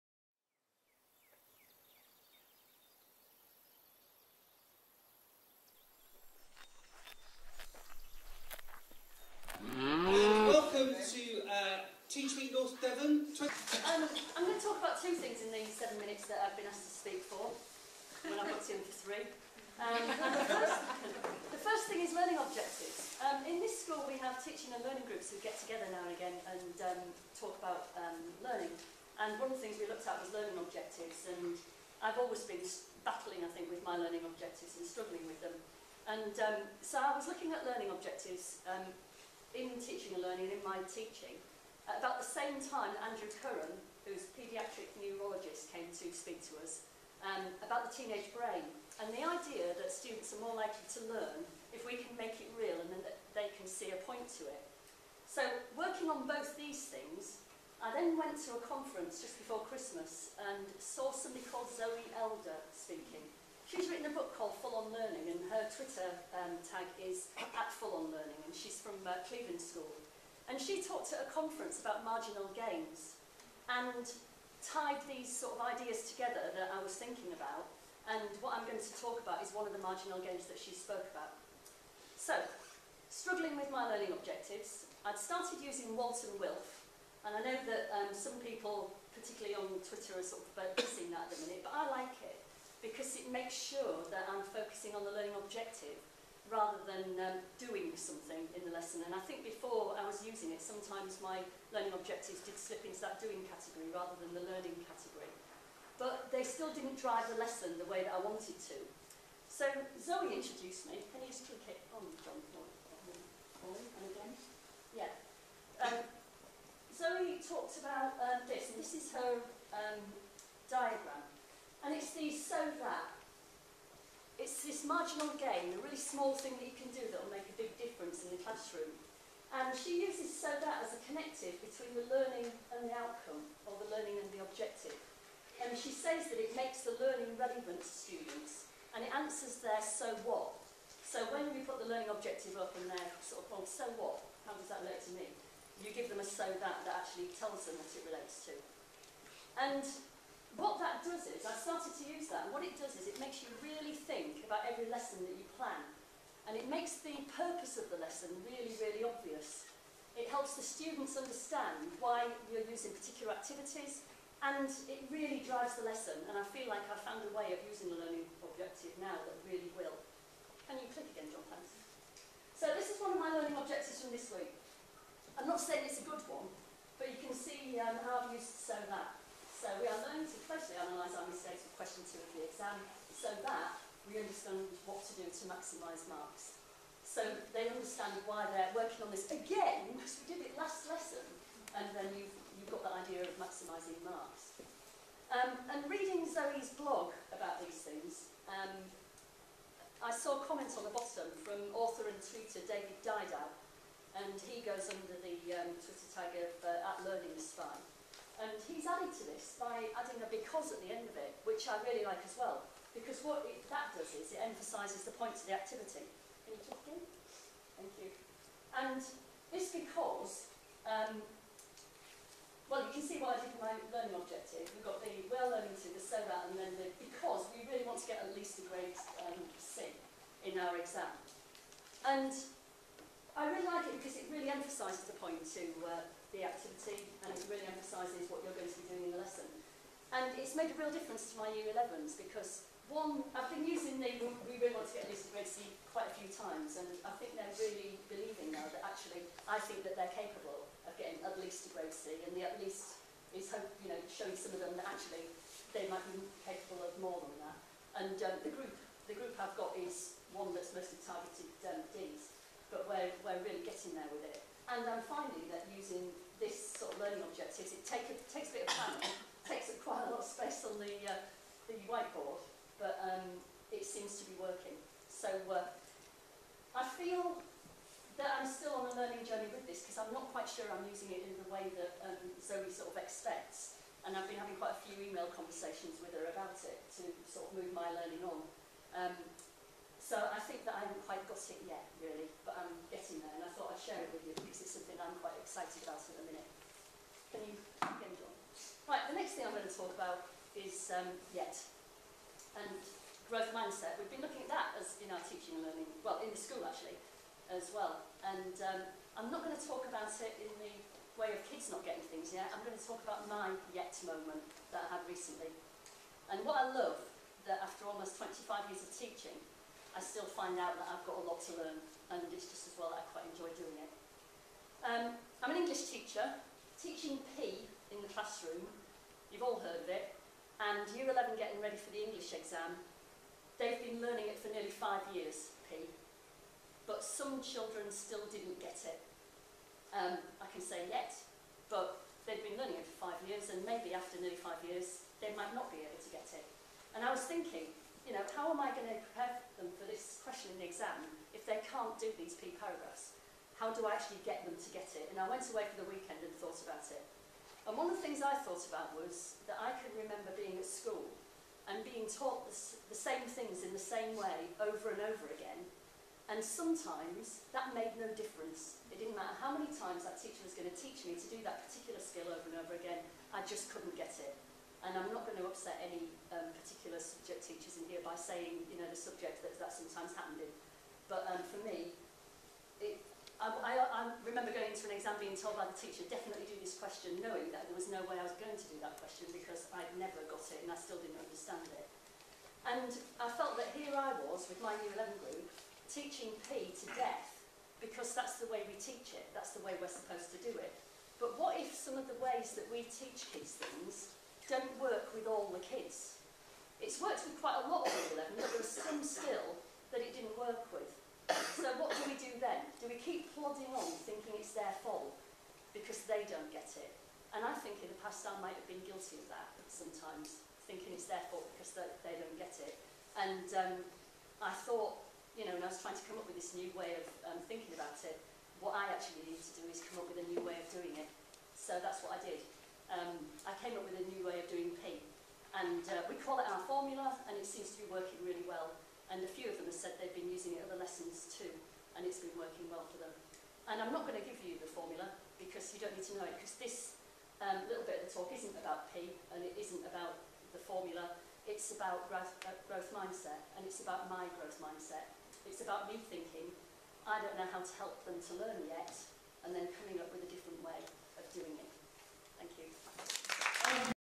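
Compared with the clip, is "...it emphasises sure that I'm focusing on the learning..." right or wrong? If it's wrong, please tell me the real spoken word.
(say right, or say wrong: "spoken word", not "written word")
wrong: "makes", not "emphasises".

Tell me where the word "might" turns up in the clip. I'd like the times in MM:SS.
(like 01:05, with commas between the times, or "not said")
04:15, 05:45, 06:58.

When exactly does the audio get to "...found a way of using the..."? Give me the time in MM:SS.
02:47.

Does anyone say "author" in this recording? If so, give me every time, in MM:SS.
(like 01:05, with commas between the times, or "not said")
03:21.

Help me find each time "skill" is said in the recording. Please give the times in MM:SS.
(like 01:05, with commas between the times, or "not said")
06:12, 06:49.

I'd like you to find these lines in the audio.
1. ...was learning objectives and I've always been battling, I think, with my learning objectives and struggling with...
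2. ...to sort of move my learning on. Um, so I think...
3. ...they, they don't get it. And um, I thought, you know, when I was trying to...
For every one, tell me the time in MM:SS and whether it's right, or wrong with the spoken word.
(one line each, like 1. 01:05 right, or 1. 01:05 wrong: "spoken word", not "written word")
1. 00:30 right
2. 04:47 right
3. 07:01 right.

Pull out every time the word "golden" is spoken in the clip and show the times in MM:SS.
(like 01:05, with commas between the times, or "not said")
not said.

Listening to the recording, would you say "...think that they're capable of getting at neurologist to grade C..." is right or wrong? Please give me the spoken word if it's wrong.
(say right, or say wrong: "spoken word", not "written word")
wrong: "least", not "neurologist".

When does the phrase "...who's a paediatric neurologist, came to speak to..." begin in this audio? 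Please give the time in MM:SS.
00:44.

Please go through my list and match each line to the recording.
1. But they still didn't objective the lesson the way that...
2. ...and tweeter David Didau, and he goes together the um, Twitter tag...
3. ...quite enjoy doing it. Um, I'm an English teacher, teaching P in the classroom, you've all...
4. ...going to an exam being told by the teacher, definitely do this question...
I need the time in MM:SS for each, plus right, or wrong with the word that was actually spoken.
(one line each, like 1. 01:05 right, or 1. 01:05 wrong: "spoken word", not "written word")
1. 01:45 wrong: "drive", not "objective"
2. 03:22 wrong: "under", not "together"
3. 05:23 right
4. 06:24 right.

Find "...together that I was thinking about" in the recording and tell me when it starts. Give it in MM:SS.
01:16.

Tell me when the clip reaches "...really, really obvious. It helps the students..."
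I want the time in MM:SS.
02:38.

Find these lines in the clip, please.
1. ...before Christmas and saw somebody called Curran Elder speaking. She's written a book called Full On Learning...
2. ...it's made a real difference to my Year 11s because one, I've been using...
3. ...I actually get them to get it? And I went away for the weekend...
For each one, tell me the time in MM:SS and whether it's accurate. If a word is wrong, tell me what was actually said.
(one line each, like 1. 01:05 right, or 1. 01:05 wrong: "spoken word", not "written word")
1. 00:59 wrong: "Zoe", not "Curran"
2. 04:00 right
3. 05:53 right.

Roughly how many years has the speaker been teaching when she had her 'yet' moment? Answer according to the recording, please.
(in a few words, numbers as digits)
25.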